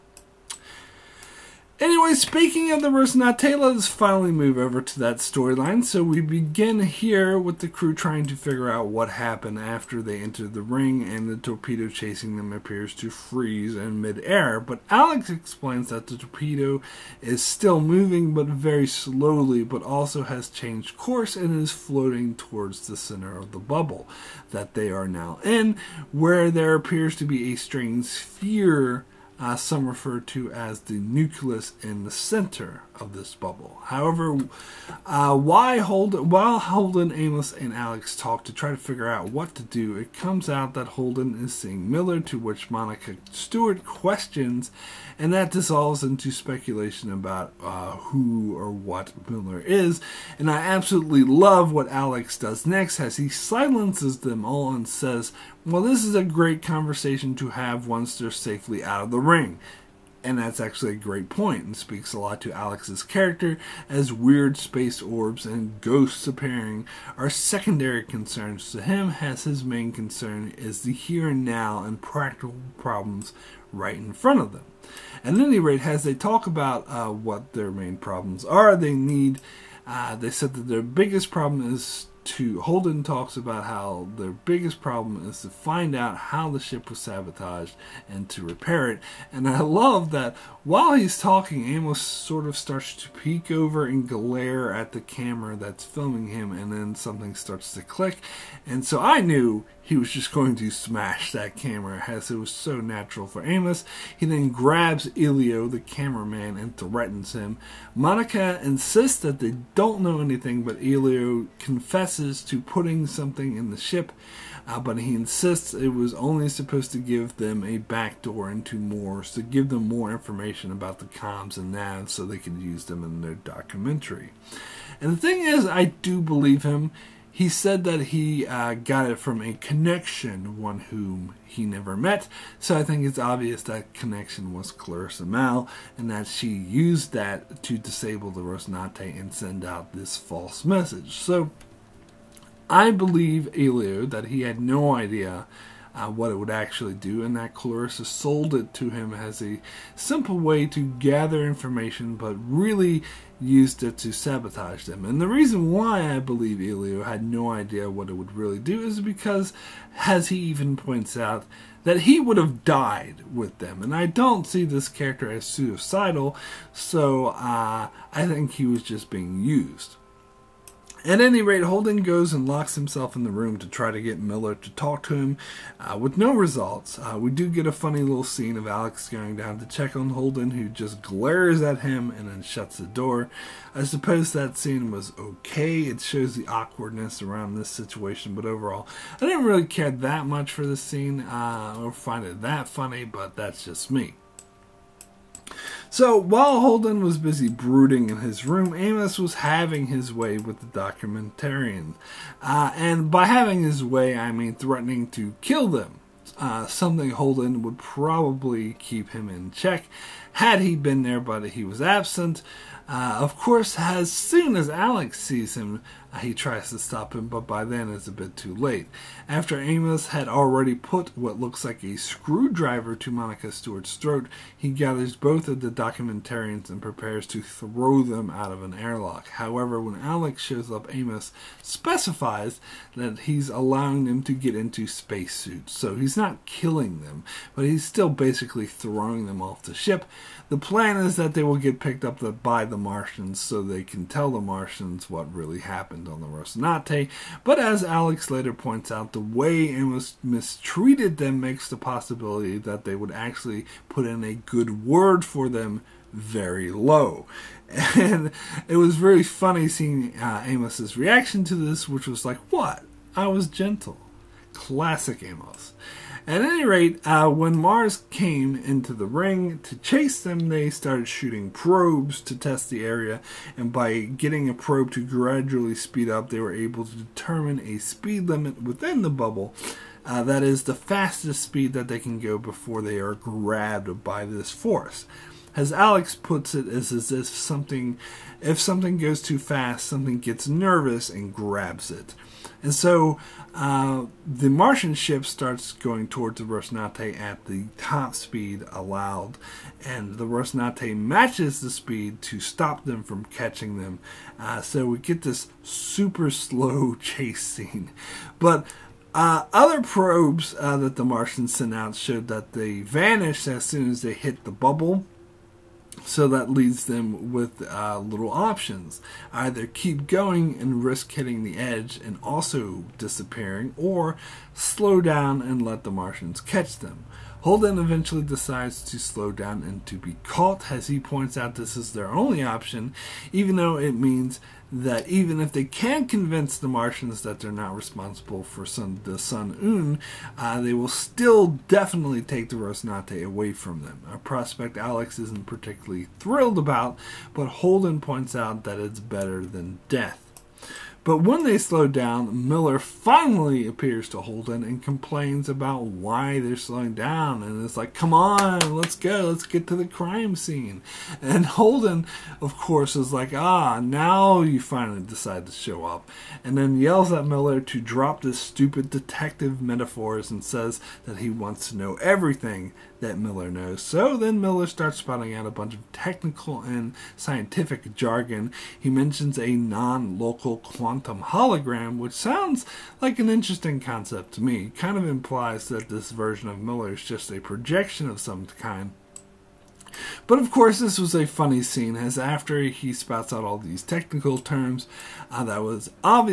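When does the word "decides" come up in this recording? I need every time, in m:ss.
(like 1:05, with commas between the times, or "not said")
5:28, 6:05.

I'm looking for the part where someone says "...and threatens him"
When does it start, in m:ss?
1:46.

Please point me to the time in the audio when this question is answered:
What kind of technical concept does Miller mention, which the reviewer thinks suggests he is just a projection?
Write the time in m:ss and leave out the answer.
6:19.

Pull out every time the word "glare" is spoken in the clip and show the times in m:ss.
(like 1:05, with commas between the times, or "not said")
1:34, 3:01.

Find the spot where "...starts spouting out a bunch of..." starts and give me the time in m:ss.
6:14.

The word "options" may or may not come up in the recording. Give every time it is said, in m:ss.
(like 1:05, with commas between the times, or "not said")
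5:18, 5:32.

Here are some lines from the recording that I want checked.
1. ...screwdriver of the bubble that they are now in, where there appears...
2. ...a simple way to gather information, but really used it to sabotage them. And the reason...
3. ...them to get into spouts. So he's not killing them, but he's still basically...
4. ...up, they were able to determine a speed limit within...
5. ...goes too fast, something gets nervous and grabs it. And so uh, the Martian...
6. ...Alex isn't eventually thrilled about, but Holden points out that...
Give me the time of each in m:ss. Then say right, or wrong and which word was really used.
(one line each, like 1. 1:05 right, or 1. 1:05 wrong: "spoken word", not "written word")
1. 0:22 wrong: "center", not "screwdriver"
2. 2:29 right
3. 3:54 wrong: "spacesuits", not "spouts"
4. 4:36 right
5. 4:48 right
6. 5:44 wrong: "particularly", not "eventually".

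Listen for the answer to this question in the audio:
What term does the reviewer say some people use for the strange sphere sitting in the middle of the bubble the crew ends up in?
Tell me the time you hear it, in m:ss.
0:30.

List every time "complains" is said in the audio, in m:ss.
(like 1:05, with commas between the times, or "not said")
5:54.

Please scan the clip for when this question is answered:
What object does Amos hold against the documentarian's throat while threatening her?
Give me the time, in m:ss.
3:41.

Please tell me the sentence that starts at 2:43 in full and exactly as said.
And I don't see this character as suicidal, so uh, I think he was just being used.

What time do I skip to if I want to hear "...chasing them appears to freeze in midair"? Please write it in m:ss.
0:11.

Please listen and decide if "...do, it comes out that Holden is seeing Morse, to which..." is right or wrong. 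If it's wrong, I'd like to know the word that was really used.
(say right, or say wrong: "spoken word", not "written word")
wrong: "Miller", not "Morse".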